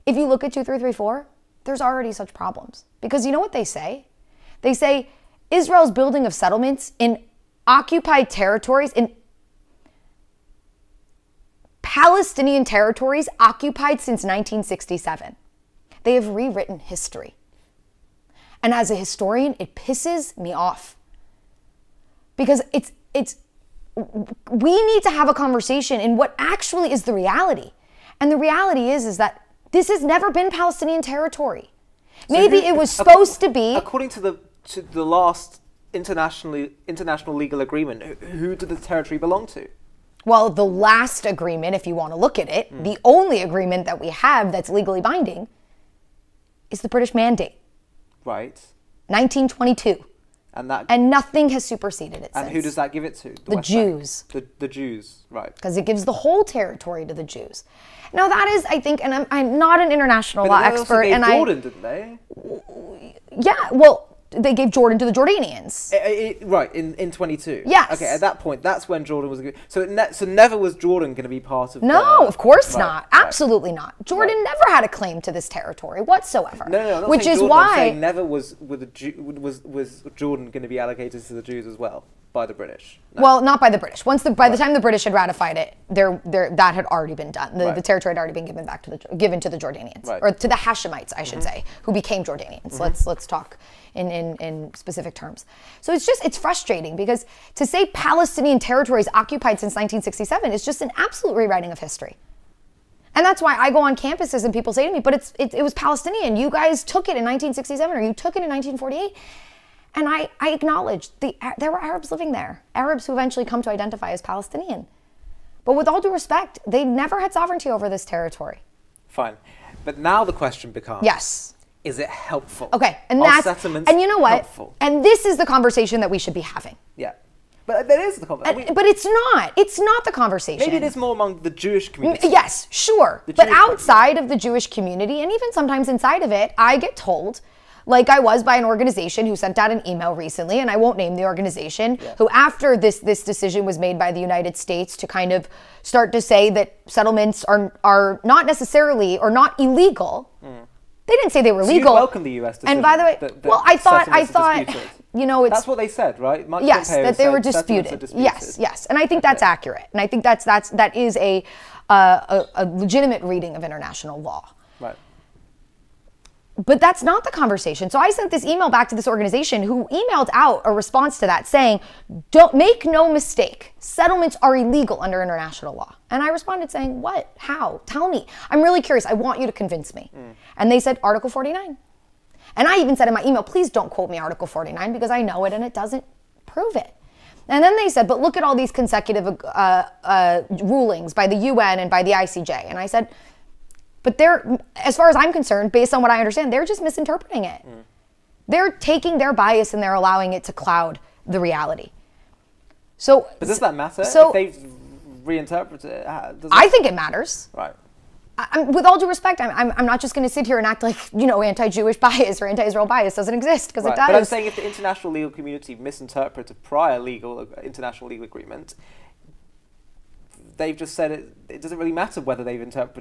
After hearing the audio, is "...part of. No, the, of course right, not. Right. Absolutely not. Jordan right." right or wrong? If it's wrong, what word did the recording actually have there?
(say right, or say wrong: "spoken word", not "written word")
right.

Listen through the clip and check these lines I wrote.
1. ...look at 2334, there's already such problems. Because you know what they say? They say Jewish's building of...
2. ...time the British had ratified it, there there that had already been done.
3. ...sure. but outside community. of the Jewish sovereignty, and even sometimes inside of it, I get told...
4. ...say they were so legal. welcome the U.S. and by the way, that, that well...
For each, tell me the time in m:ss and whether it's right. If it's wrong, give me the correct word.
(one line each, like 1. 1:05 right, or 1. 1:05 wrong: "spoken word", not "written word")
1. 0:00 wrong: "Israel", not "Jewish"
2. 1:24 right
3. 2:12 wrong: "community", not "sovereignty"
4. 2:31 right.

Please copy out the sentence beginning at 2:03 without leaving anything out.
And Are that's And you know what?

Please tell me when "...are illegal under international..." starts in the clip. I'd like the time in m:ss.
2:54.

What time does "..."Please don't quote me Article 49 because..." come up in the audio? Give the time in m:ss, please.
3:03.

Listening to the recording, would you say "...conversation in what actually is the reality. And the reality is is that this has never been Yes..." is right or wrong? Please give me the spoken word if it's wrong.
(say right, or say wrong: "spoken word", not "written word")
wrong: "Palestinian", not "Yes".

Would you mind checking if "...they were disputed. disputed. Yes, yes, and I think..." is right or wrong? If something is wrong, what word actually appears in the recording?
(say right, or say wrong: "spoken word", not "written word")
right.